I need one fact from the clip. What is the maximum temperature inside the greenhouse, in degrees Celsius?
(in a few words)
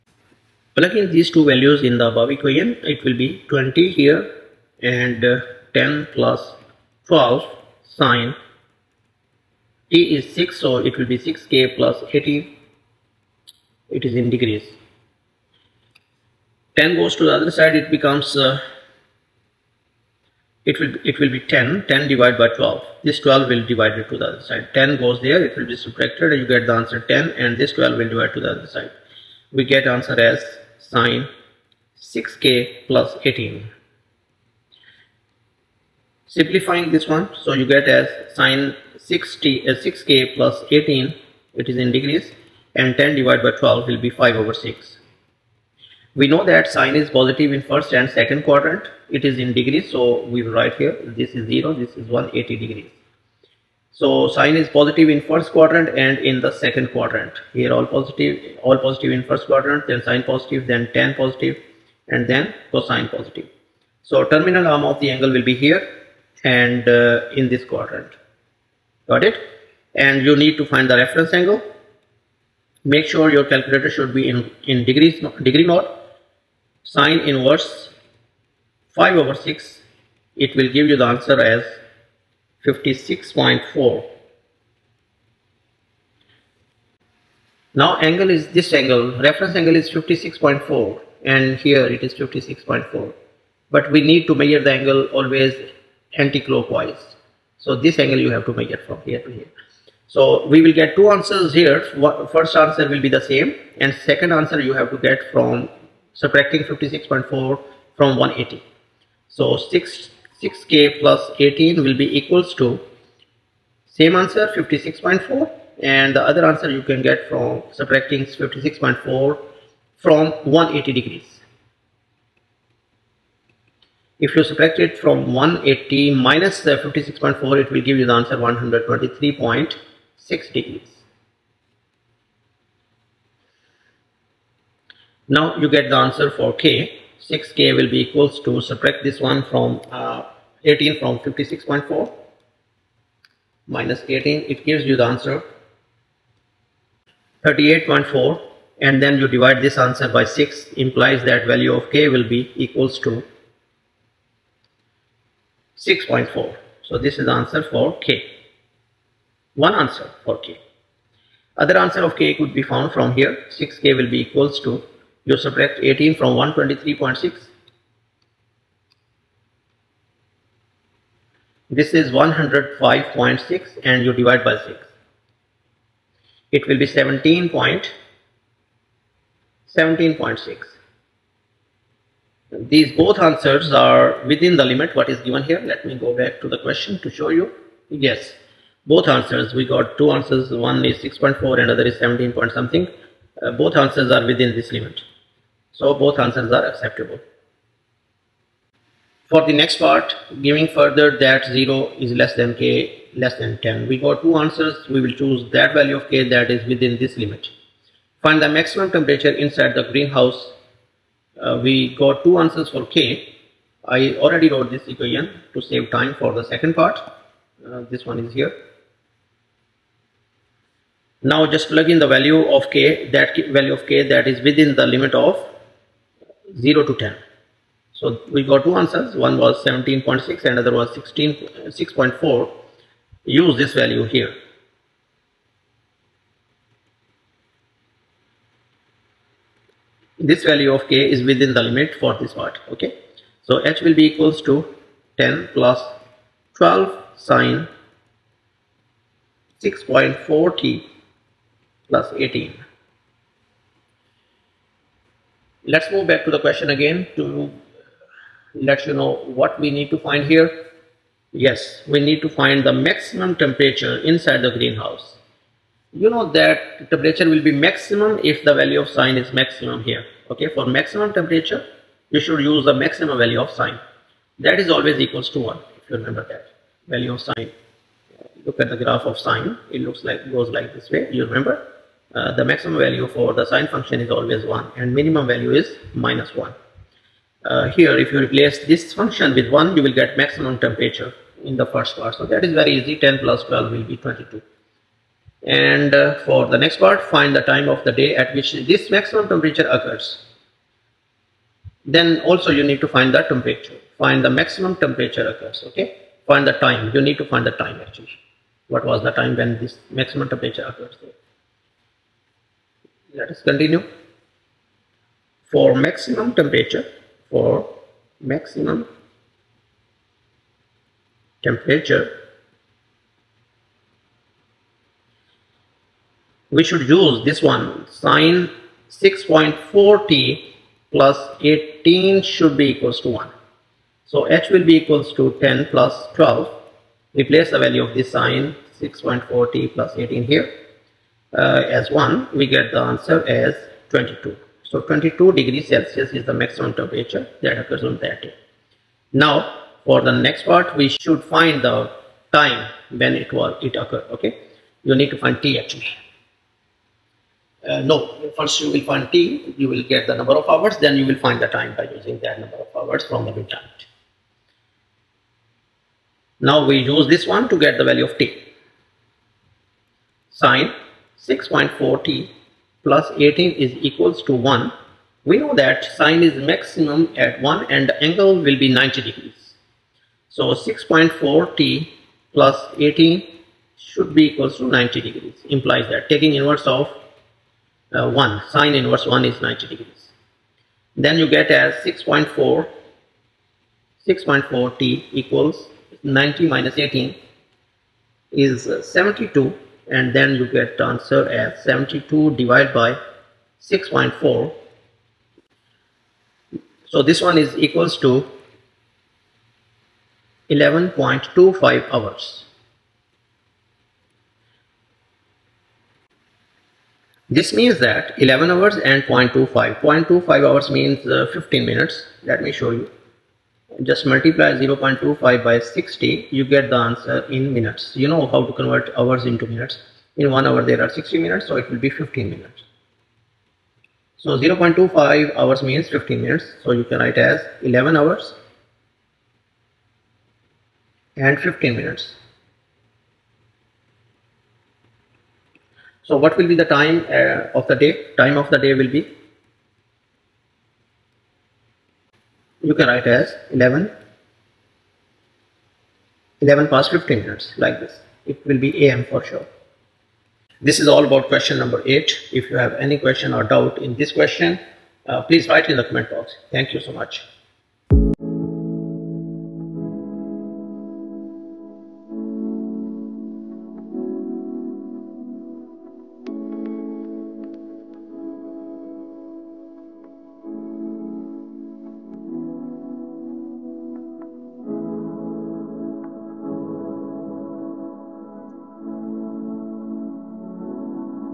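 22.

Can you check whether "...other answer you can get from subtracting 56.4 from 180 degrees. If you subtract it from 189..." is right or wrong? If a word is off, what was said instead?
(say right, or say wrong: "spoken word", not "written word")
wrong: "180", not "189".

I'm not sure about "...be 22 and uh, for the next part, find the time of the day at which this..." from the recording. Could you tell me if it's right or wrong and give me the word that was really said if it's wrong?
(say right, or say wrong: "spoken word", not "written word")
right.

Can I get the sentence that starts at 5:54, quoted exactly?
Okay, you need to find t actually.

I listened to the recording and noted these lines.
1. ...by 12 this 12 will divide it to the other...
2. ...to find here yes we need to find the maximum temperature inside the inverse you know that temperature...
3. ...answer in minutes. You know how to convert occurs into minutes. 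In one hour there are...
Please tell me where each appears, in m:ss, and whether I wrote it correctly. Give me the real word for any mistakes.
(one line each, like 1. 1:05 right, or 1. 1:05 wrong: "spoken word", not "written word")
1. 0:22 right
2. 4:19 wrong: "greenhouse", not "inverse"
3. 7:06 wrong: "hours", not "occurs".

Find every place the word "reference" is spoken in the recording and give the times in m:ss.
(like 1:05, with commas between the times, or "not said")
1:10, 1:29.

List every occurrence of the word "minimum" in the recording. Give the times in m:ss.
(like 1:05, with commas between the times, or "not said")
4:44.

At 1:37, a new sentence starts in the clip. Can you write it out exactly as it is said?
So this angle you have to measure from here to here.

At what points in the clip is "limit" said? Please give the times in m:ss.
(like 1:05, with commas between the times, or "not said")
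3:04, 3:14, 3:27, 3:44, 4:01.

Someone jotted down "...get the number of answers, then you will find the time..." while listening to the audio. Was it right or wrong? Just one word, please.
wrong.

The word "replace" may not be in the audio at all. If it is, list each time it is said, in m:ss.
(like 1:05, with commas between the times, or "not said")
4:48, 5:37.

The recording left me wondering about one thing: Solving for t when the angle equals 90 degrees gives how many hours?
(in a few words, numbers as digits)
11.25 hours.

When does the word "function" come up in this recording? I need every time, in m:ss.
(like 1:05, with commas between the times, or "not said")
4:43, 4:48.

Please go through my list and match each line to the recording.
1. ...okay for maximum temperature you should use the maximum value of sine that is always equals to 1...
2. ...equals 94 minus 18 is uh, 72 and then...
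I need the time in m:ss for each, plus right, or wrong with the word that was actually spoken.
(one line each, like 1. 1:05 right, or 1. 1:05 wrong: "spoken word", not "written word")
1. 4:30 right
2. 6:35 wrong: "90", not "94".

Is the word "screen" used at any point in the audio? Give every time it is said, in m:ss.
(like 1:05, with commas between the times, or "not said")
not said.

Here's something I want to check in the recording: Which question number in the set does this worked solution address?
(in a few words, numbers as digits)
8.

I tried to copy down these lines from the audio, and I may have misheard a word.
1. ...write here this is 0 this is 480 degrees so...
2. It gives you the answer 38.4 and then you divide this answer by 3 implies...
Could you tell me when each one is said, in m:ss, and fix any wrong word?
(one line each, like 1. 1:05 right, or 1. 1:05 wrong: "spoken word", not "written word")
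1. 0:50 wrong: "180", not "480"
2. 2:24 wrong: "6", not "3".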